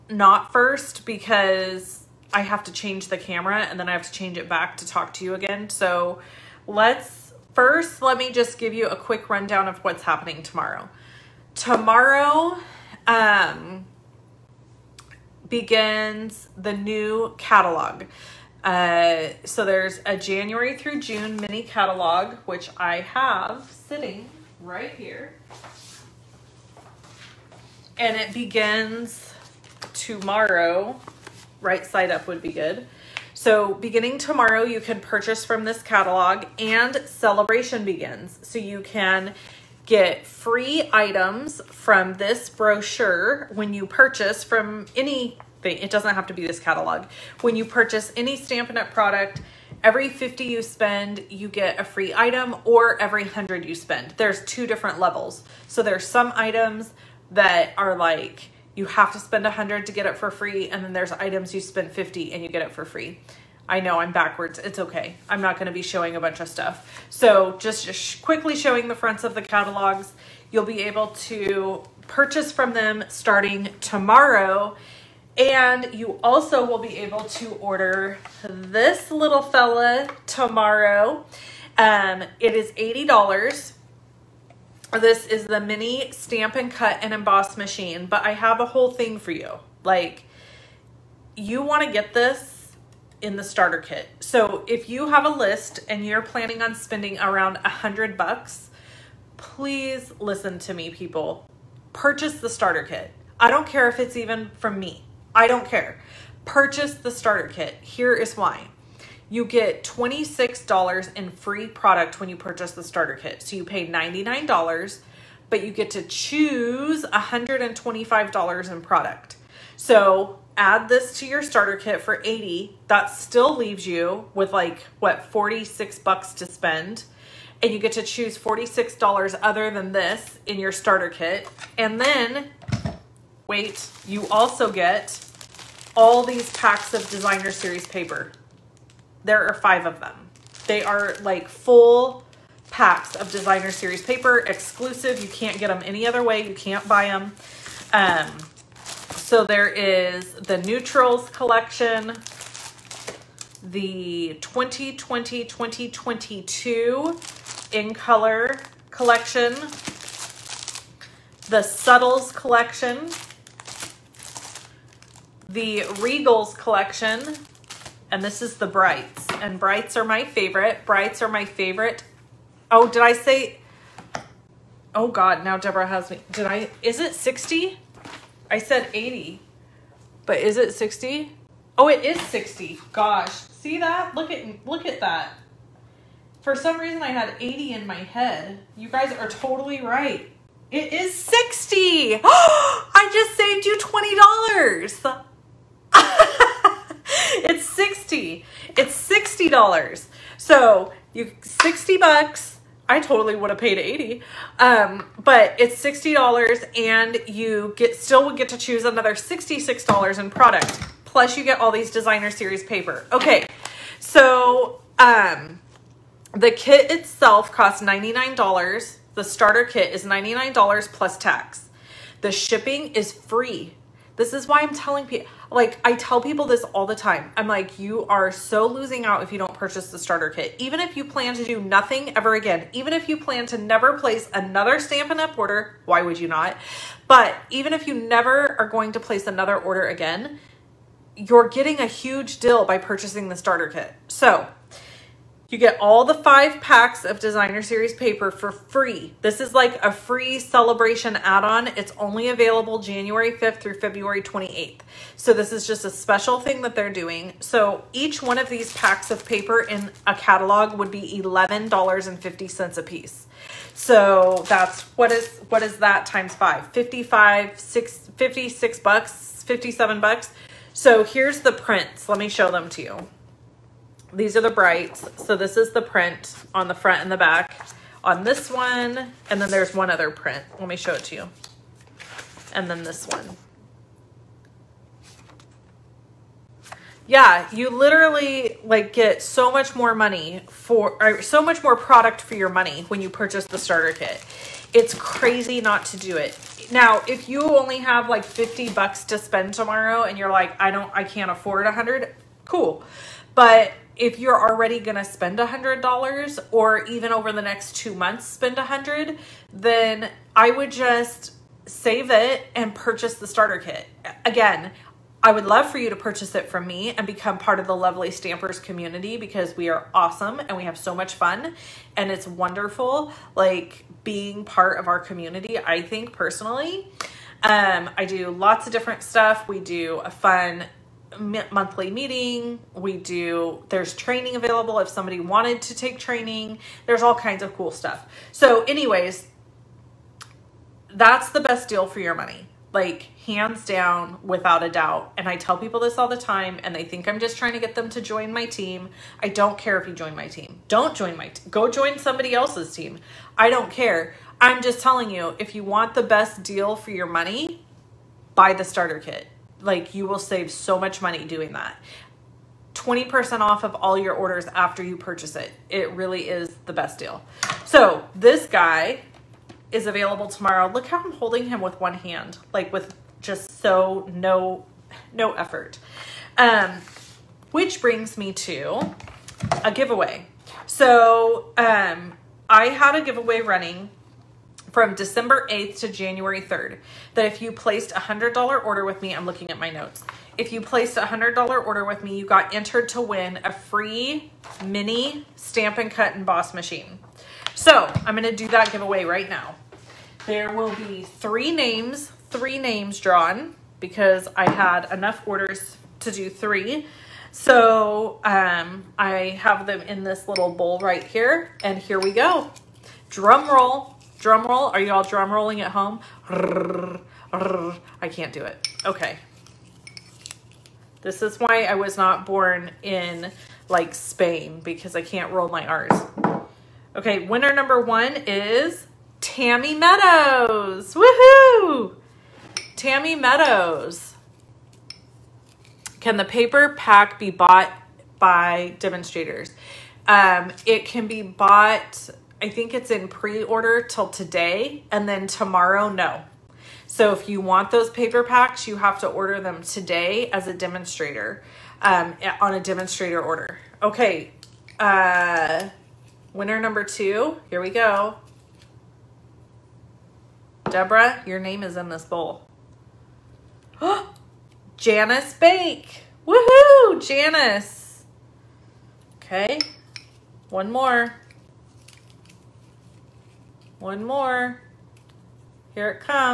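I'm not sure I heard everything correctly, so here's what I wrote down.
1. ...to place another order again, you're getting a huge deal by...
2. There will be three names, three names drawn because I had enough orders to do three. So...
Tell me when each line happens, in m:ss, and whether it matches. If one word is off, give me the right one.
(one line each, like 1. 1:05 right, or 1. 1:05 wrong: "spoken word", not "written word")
1. 3:58 right
2. 6:40 right.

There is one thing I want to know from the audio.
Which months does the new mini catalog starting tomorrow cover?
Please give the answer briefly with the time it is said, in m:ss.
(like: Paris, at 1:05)
January through June, at 0:20.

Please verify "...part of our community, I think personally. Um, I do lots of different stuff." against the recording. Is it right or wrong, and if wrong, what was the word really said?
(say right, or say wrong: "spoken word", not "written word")
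right.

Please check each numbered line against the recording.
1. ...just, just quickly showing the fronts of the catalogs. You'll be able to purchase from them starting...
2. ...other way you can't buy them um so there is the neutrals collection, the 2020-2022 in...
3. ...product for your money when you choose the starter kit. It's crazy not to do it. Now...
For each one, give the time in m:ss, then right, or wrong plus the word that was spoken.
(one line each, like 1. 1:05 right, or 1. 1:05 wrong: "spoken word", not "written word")
1. 1:07 right
2. 2:26 right
3. 4:51 wrong: "purchase", not "choose".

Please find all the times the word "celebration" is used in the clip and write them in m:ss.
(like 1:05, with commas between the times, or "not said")
0:37, 4:10.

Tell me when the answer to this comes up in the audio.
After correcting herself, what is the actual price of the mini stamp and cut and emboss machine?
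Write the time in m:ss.
3:01.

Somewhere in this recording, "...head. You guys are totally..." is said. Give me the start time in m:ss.
3:08.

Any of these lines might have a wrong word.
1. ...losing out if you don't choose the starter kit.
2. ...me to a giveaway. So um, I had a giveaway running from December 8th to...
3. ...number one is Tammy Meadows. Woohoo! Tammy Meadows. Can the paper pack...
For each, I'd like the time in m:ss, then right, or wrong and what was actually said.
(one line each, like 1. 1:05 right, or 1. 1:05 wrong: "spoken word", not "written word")
1. 3:48 wrong: "purchase", not "choose"
2. 6:18 right
3. 7:07 right.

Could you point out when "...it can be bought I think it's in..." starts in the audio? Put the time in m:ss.
7:20.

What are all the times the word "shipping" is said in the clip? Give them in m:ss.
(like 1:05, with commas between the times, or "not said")
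3:42.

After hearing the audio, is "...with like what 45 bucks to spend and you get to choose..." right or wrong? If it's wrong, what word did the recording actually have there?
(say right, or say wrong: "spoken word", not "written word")
wrong: "46", not "45".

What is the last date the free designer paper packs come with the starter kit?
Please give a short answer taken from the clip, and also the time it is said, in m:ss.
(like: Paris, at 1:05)
February 28th, at 4:13.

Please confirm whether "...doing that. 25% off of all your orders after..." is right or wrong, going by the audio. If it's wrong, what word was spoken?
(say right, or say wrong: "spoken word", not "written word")
wrong: "20", not "25".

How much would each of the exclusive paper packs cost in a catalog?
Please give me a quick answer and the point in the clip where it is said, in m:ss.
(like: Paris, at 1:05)
$11.50, at 4:21.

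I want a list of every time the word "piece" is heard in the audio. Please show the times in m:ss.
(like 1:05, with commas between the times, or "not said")
4:22.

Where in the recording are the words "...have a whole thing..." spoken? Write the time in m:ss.
1:28.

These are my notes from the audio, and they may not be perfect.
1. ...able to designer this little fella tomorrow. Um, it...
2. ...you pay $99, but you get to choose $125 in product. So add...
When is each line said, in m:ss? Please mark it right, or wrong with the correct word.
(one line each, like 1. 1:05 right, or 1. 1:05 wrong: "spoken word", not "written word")
1. 1:16 wrong: "order", not "designer"
2. 1:53 right.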